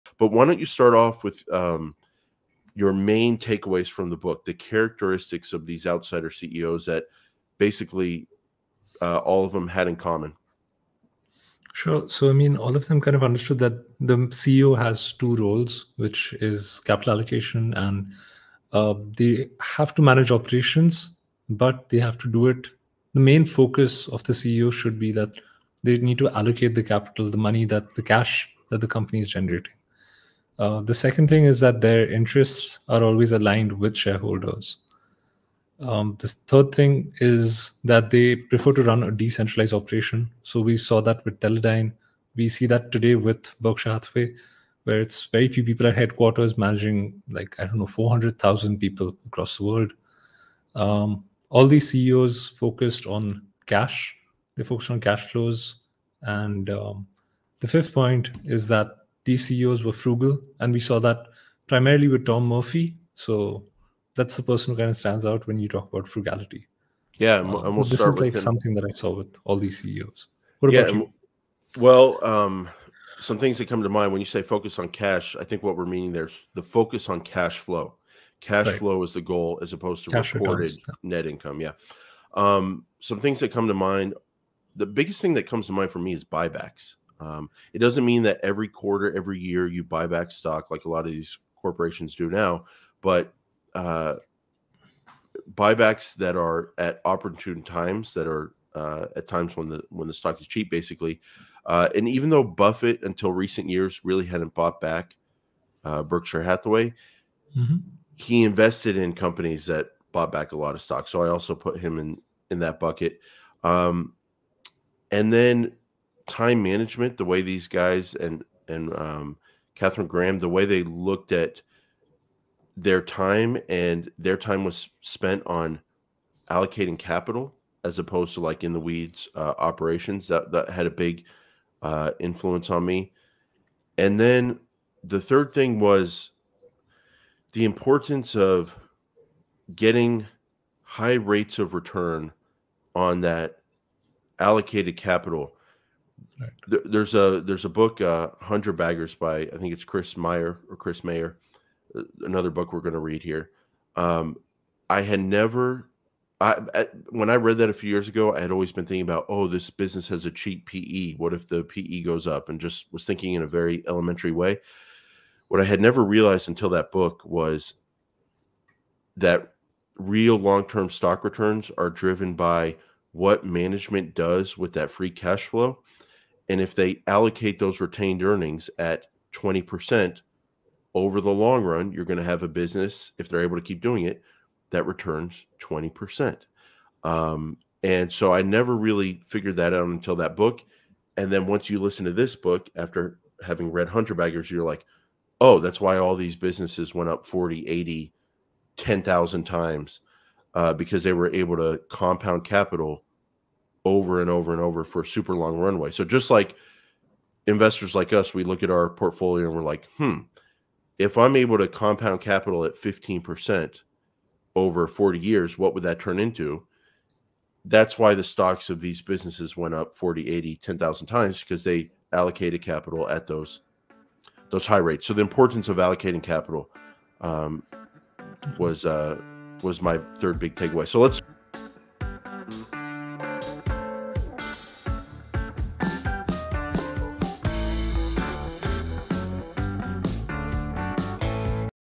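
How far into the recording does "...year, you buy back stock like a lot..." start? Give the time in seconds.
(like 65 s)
89 s.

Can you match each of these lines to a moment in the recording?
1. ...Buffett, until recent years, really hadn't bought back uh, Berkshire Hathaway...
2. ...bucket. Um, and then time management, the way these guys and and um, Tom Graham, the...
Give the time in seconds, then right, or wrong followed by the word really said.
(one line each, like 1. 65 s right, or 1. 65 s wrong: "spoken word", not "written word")
1. 102 s right
2. 112 s wrong: "Katharine", not "Tom".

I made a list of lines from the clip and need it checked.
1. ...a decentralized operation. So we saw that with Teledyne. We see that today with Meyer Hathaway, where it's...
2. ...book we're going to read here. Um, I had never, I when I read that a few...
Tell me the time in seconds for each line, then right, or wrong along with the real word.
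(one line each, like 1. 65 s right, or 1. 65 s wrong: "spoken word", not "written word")
1. 39 s wrong: "Berkshire", not "Meyer"
2. 152 s right.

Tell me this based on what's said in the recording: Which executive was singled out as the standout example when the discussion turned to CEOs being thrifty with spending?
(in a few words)
Tom Murphy.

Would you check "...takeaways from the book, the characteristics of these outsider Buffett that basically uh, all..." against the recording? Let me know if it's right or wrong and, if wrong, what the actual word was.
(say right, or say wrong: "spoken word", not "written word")
wrong: "CEOs", not "Buffett".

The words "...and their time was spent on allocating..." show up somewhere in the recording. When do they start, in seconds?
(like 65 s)
123 s.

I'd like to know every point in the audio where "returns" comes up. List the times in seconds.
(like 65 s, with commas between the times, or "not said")
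80 s, 141 s, 171 s, 184 s.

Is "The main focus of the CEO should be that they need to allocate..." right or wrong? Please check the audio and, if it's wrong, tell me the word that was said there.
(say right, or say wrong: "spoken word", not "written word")
right.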